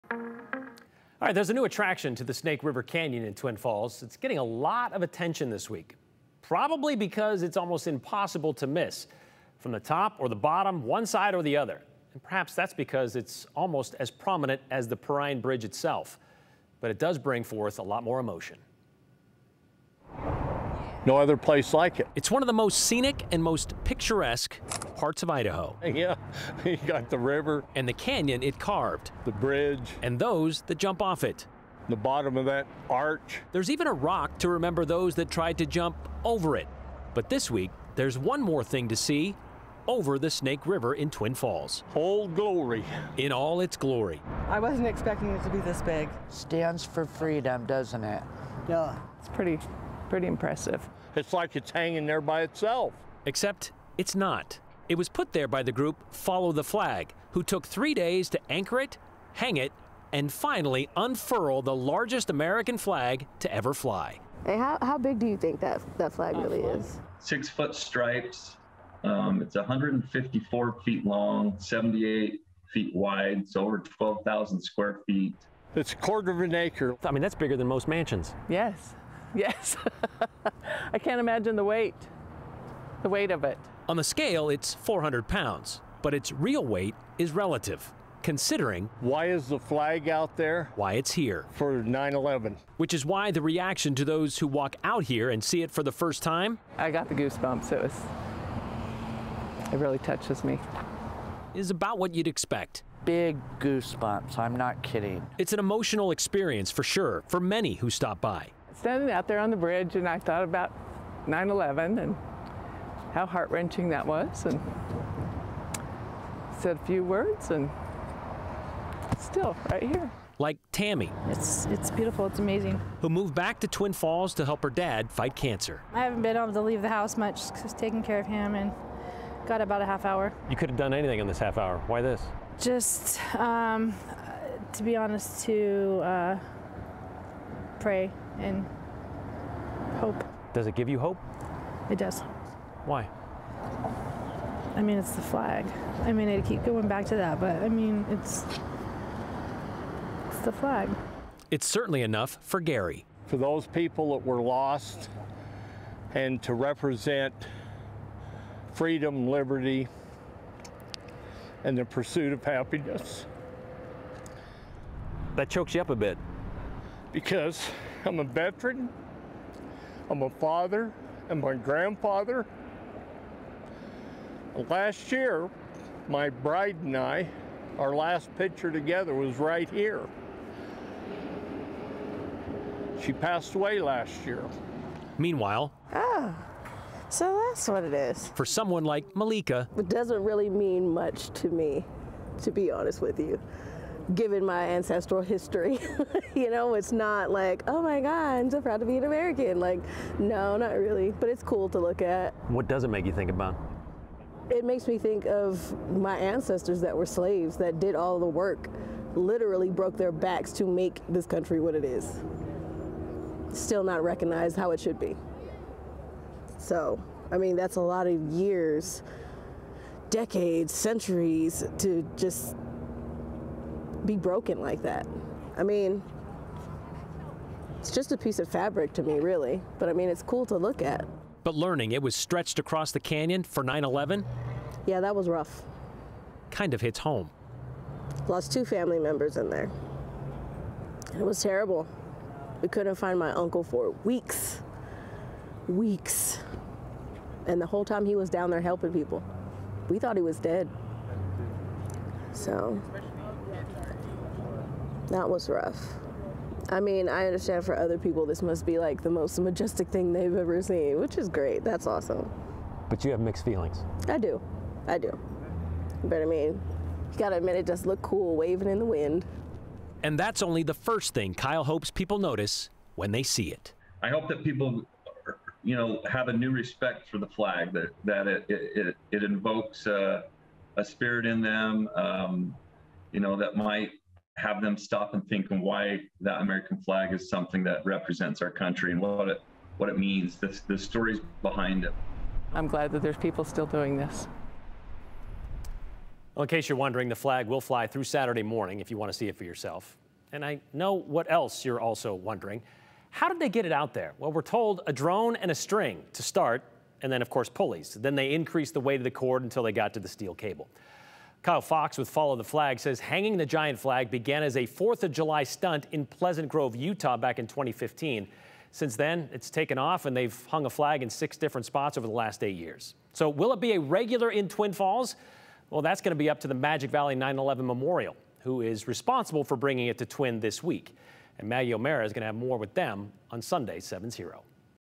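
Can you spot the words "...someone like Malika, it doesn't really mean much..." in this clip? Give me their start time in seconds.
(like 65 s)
188 s.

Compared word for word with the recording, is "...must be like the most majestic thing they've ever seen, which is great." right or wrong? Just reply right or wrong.
right.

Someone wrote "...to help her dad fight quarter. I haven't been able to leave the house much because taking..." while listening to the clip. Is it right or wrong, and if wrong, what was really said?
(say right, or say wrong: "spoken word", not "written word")
wrong: "cancer", not "quarter".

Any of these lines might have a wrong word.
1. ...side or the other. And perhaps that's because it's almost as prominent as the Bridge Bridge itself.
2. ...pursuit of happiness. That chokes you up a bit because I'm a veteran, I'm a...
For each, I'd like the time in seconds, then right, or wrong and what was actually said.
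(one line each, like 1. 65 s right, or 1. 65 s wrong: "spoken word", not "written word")
1. 11 s wrong: "Perrine", not "Bridge"
2. 161 s right.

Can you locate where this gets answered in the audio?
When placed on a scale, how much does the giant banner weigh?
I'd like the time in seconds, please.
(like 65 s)
84 s.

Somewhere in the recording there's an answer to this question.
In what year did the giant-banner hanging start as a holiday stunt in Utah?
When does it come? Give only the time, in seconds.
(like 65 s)
317 s.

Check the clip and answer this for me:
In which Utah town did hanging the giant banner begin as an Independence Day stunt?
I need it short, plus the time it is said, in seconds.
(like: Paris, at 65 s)
Pleasant Grove, at 316 s.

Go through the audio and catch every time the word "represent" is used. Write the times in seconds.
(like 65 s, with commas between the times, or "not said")
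156 s, 287 s.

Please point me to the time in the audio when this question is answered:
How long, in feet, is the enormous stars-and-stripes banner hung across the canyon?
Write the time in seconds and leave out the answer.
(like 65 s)
69 s.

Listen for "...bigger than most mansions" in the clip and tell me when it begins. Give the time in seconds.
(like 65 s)
77 s.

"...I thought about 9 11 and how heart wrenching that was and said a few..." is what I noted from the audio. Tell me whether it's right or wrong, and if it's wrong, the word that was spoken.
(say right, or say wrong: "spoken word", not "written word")
right.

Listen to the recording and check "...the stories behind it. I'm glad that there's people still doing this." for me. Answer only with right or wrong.
right.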